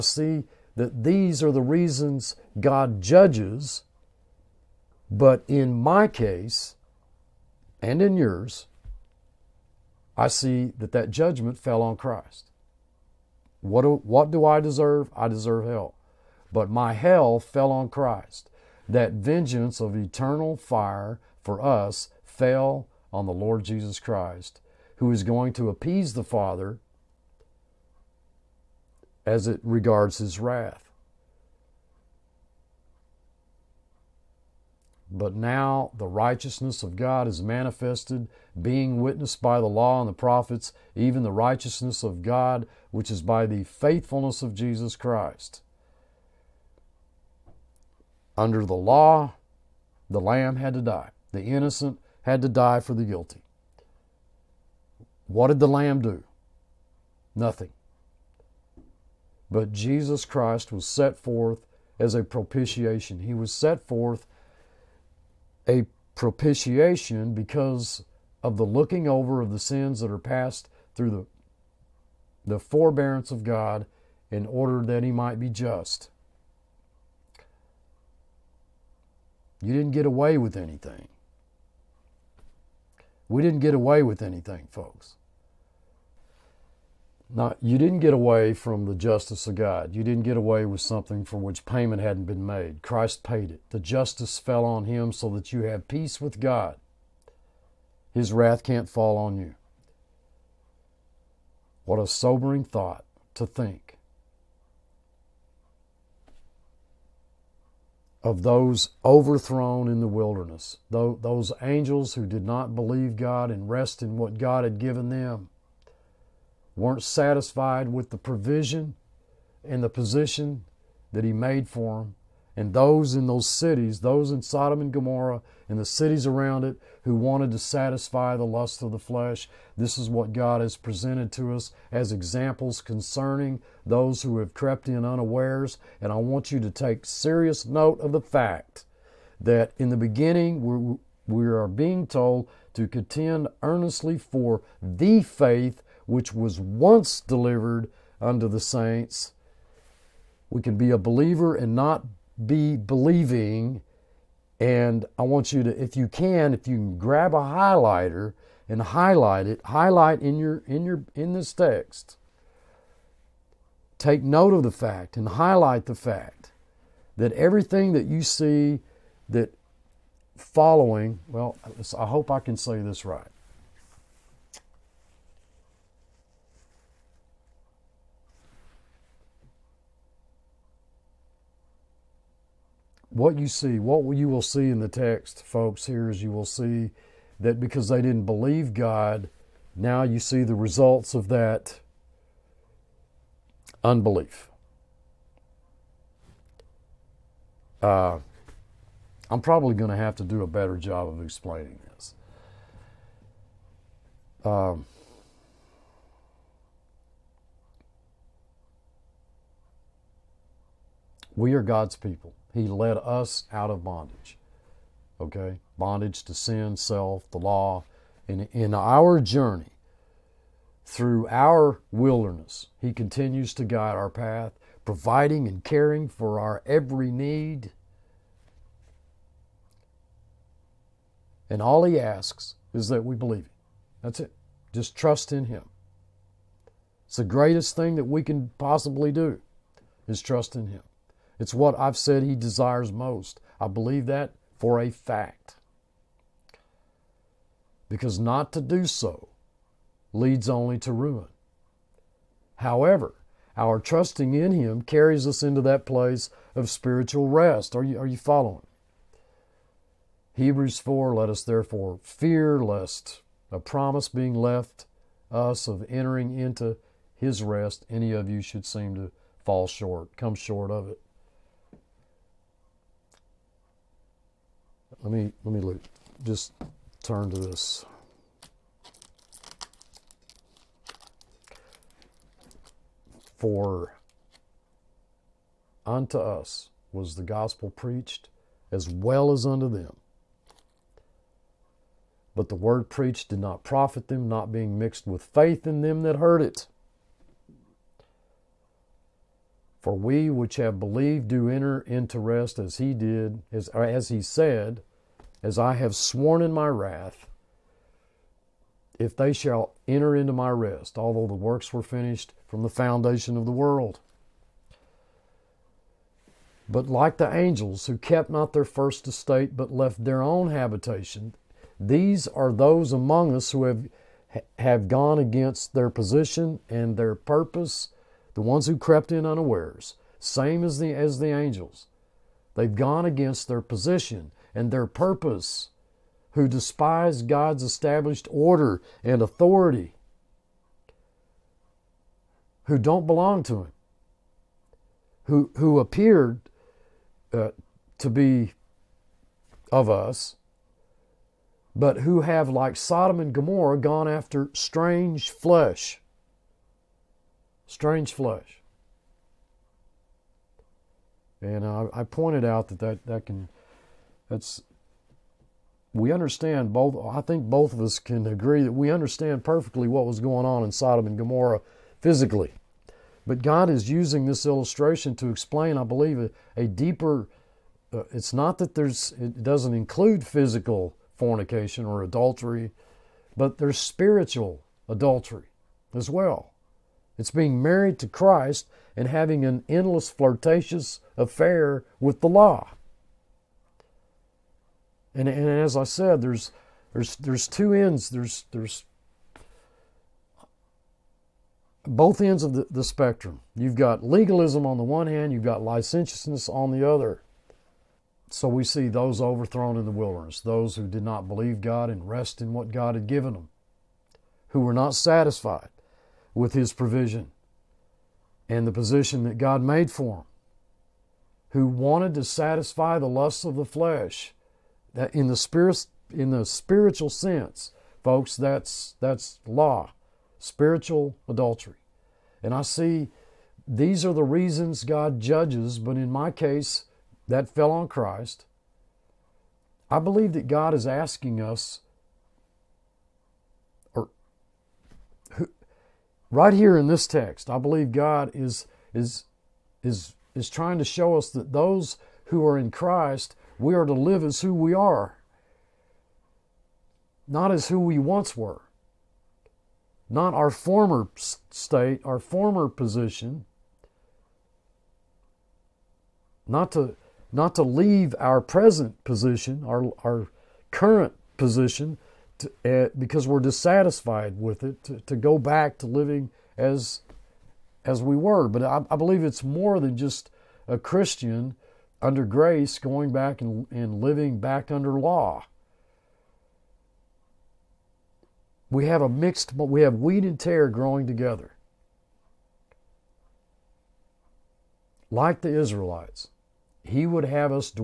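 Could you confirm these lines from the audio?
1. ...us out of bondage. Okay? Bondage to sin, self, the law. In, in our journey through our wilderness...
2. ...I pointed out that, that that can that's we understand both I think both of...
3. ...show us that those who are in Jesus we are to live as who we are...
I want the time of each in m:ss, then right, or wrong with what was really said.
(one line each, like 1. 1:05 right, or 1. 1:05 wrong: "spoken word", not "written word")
1. 3:32 right
2. 6:01 right
3. 7:30 wrong: "Christ", not "Jesus".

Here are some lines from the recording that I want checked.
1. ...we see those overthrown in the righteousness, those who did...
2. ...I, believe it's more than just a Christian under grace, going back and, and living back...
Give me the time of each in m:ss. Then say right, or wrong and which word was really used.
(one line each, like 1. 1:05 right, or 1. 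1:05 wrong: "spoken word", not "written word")
1. 6:48 wrong: "wilderness", not "righteousness"
2. 7:58 right.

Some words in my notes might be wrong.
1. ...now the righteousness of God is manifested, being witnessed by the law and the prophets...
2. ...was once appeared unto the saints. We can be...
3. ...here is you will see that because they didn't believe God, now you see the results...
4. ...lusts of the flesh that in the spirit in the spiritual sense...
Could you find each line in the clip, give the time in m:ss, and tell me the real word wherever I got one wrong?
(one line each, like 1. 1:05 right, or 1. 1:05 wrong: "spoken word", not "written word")
1. 0:35 right
2. 2:26 wrong: "delivered", not "appeared"
3. 3:05 right
4. 7:03 right.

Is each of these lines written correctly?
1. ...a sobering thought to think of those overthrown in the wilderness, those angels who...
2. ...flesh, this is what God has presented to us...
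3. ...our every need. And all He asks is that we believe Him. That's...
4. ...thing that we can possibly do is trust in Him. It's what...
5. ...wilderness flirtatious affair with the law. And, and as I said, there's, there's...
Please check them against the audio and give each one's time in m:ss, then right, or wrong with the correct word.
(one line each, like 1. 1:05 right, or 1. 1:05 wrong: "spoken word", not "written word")
1. 1:41 right
2. 2:08 right
3. 3:46 right
4. 3:57 right
5. 6:29 wrong: "endless", not "wilderness".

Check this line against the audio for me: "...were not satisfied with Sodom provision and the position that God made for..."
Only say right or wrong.
wrong.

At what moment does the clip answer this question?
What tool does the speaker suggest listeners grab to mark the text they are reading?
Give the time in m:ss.
2:37.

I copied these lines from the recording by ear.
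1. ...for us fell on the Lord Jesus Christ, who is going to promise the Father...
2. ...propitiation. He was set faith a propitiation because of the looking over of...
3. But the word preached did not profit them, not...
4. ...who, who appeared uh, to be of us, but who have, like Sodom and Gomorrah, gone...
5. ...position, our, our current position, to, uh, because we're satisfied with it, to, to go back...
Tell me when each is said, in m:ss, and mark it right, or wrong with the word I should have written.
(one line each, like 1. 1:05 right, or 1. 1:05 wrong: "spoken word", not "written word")
1. 0:21 wrong: "appease", not "promise"
2. 1:02 wrong: "forth", not "faith"
3. 4:52 right
4. 5:45 right
5. 7:49 wrong: "dissatisfied", not "satisfied".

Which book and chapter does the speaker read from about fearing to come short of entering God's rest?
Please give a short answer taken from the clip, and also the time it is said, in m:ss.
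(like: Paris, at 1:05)
Hebrews 4, at 4:20.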